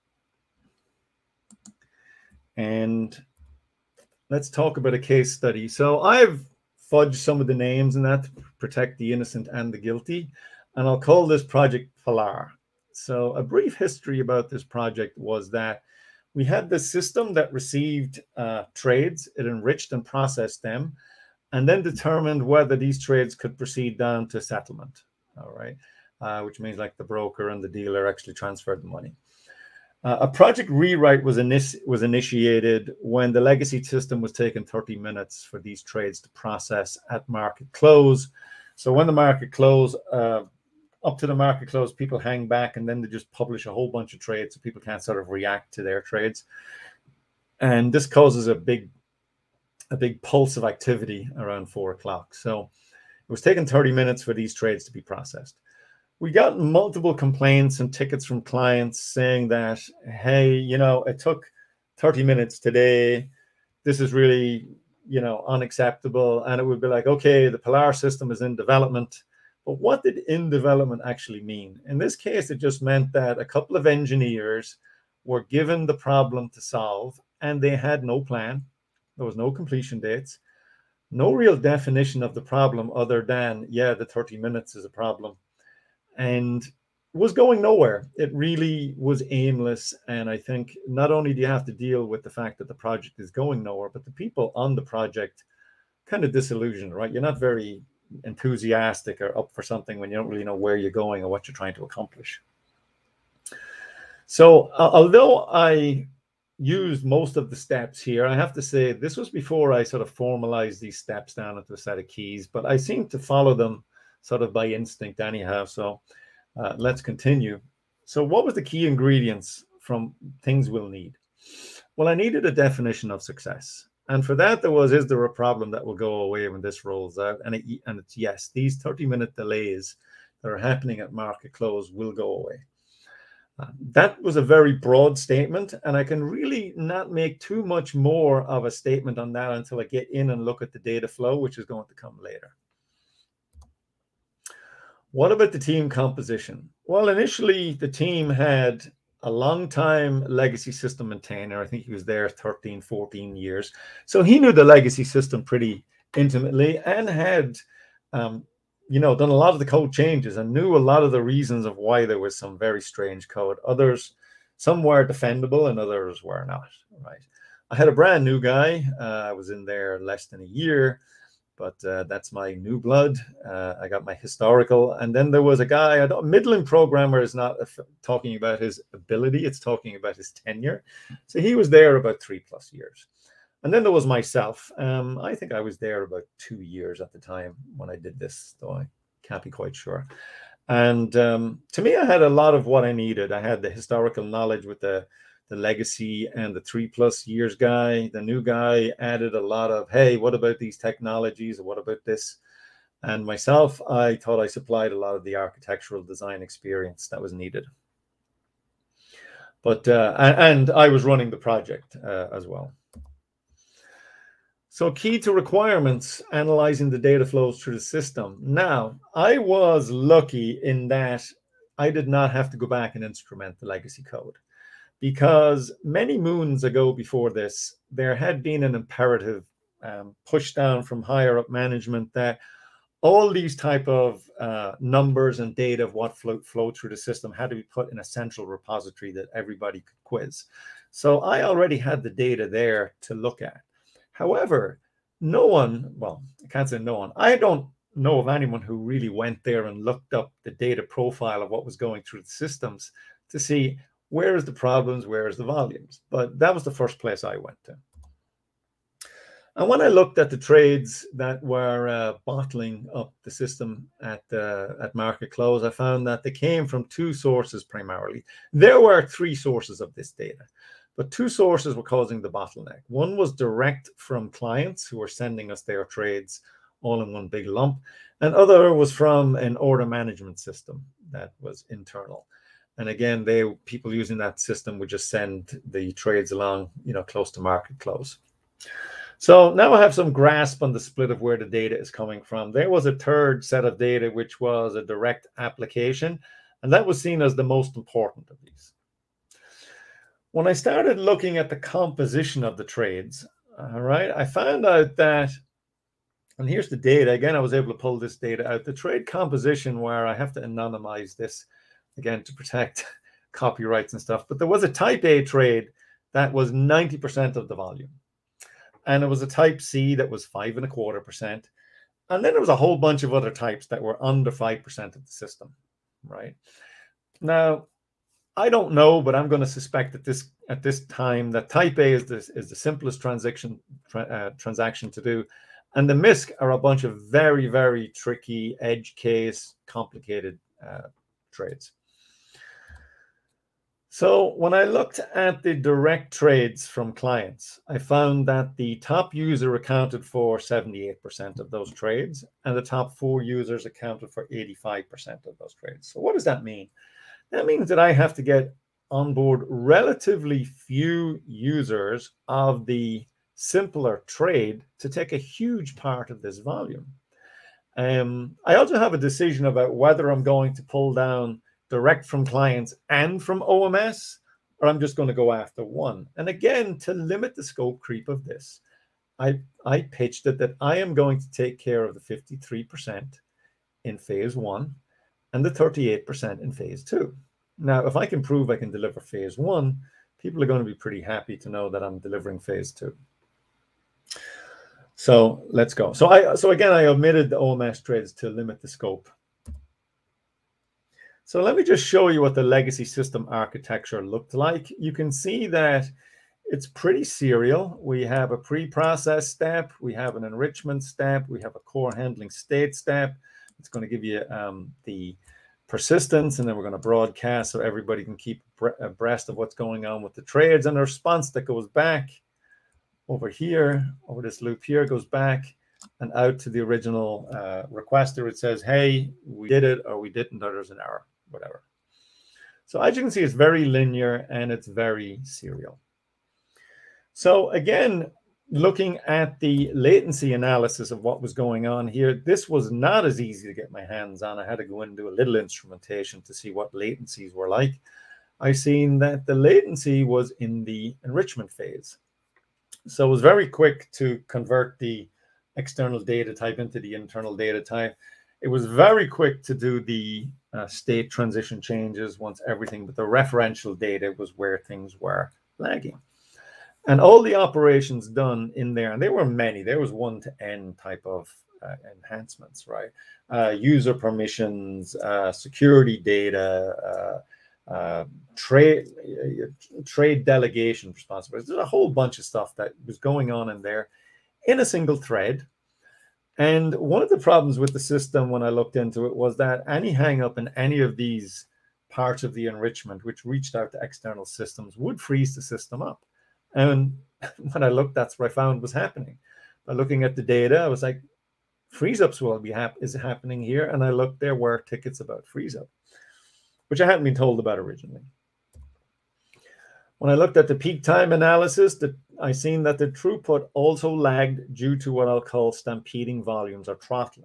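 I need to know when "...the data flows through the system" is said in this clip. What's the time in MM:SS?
03:36.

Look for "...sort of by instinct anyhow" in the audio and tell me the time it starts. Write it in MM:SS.
01:54.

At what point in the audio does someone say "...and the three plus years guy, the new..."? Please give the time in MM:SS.
03:16.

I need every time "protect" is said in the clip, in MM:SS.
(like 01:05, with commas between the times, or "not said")
00:08, 05:12.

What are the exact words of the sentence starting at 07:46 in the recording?
And all the operations done in there, and there were many, there was one to N type of uh, enhancements, right?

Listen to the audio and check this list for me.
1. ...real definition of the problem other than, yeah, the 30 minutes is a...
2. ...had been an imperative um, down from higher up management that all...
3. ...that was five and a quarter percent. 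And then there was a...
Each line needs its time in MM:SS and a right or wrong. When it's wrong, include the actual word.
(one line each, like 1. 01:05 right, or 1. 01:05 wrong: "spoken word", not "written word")
1. 01:21 right
2. 03:48 right
3. 05:19 right.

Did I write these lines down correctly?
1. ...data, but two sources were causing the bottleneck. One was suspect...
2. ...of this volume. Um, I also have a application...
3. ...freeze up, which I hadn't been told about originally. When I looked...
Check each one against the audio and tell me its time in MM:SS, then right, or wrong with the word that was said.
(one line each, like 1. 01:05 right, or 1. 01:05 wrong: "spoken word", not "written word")
1. 04:30 wrong: "direct", not "suspect"
2. 06:06 wrong: "decision", not "application"
3. 08:25 right.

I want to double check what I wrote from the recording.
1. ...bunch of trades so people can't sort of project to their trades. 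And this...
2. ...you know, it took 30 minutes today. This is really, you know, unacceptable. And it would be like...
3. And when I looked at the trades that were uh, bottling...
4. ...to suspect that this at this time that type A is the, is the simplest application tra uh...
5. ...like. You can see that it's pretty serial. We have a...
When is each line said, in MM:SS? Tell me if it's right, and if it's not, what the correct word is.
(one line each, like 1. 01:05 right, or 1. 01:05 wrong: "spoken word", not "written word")
1. 00:43 wrong: "react", not "project"
2. 01:00 right
3. 04:19 right
4. 05:29 wrong: "transaction", not "application"
5. 06:44 right.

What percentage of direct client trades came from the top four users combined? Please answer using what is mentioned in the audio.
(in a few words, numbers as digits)
85%.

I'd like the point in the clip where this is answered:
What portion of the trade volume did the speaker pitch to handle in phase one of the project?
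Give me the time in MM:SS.
06:21.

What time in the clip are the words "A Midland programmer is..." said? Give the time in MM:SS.
02:55.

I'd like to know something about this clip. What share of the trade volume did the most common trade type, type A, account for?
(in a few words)
90%.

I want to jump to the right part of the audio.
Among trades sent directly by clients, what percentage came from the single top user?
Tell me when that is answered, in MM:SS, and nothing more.
05:50.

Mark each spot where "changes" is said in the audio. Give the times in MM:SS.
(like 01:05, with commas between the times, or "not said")
02:39, 07:41.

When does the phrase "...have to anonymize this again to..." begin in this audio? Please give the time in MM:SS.
05:10.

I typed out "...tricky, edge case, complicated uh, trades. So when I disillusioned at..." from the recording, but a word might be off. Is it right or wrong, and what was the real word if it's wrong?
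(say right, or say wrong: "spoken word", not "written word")
wrong: "looked", not "disillusioned".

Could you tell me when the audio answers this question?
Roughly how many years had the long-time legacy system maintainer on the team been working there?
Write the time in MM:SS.
02:32.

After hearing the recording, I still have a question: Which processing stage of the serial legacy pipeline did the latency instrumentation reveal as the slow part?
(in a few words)
Enrichment phase.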